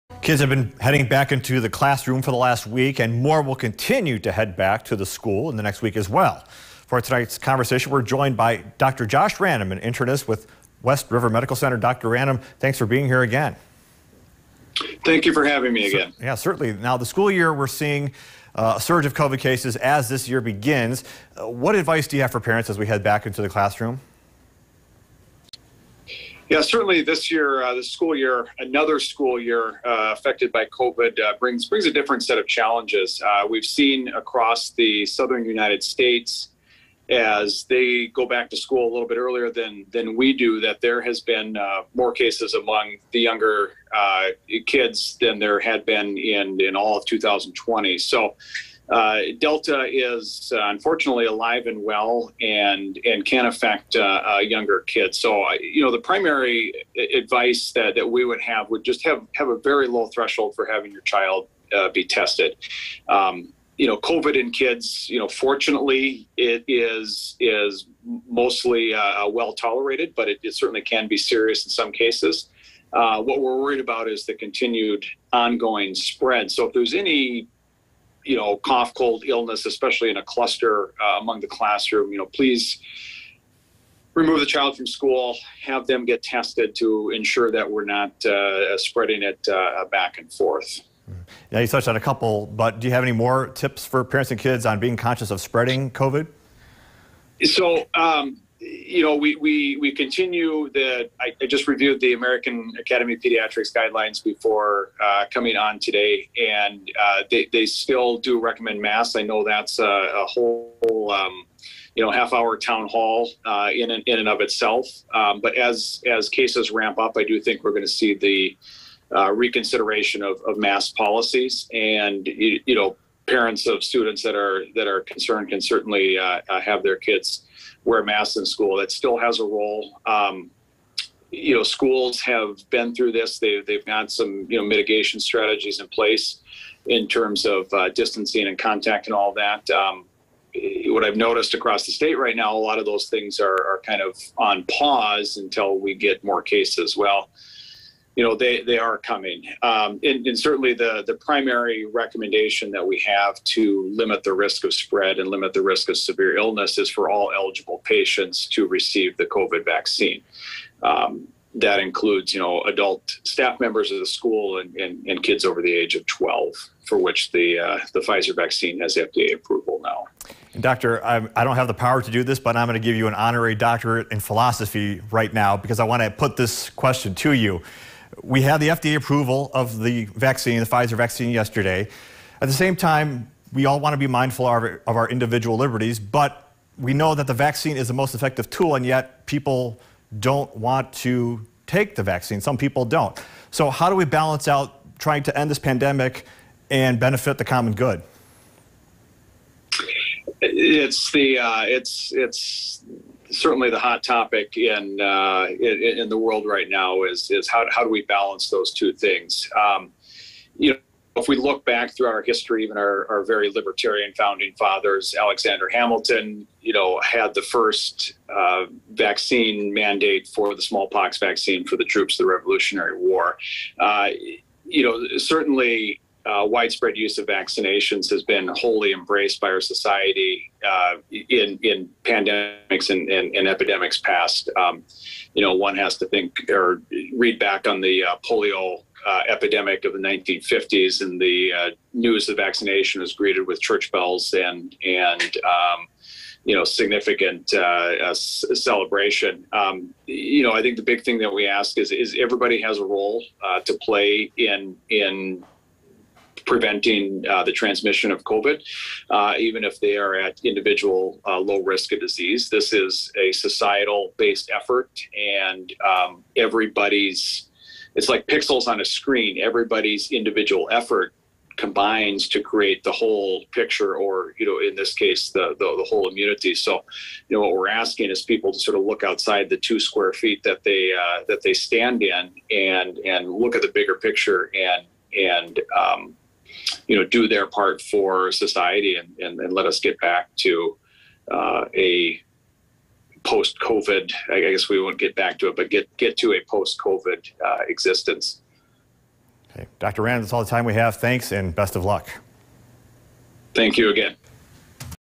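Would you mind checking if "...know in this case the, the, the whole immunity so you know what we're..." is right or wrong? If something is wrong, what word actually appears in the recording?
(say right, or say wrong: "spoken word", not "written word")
right.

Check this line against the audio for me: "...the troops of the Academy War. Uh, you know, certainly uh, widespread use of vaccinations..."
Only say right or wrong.
wrong.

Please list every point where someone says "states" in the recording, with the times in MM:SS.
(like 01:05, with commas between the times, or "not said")
00:35, 02:21.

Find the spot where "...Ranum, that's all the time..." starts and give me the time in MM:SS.
05:00.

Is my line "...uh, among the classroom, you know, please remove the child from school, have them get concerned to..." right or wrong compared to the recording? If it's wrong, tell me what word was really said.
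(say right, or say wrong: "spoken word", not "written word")
wrong: "tested", not "concerned".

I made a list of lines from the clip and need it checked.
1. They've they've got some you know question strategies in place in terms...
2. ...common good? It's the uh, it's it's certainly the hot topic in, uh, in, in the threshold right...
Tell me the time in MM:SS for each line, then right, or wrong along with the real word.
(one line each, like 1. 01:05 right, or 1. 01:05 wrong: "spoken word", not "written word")
1. 02:13 wrong: "mitigation", not "question"
2. 03:17 wrong: "world", not "threshold".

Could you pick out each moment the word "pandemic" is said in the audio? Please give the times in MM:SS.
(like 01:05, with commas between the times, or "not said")
03:15, 03:52.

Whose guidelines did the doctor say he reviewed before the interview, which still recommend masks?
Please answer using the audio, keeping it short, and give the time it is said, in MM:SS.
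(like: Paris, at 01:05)
American Academy of Pediatrics, at 01:42.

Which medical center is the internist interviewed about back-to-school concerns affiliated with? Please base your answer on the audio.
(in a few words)
West River Medical Center.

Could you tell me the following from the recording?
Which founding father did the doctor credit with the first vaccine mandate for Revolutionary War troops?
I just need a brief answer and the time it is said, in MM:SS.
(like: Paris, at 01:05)
Alexander Hamilton, at 03:35.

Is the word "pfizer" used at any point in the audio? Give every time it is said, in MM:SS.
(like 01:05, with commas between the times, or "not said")
02:48, 03:00.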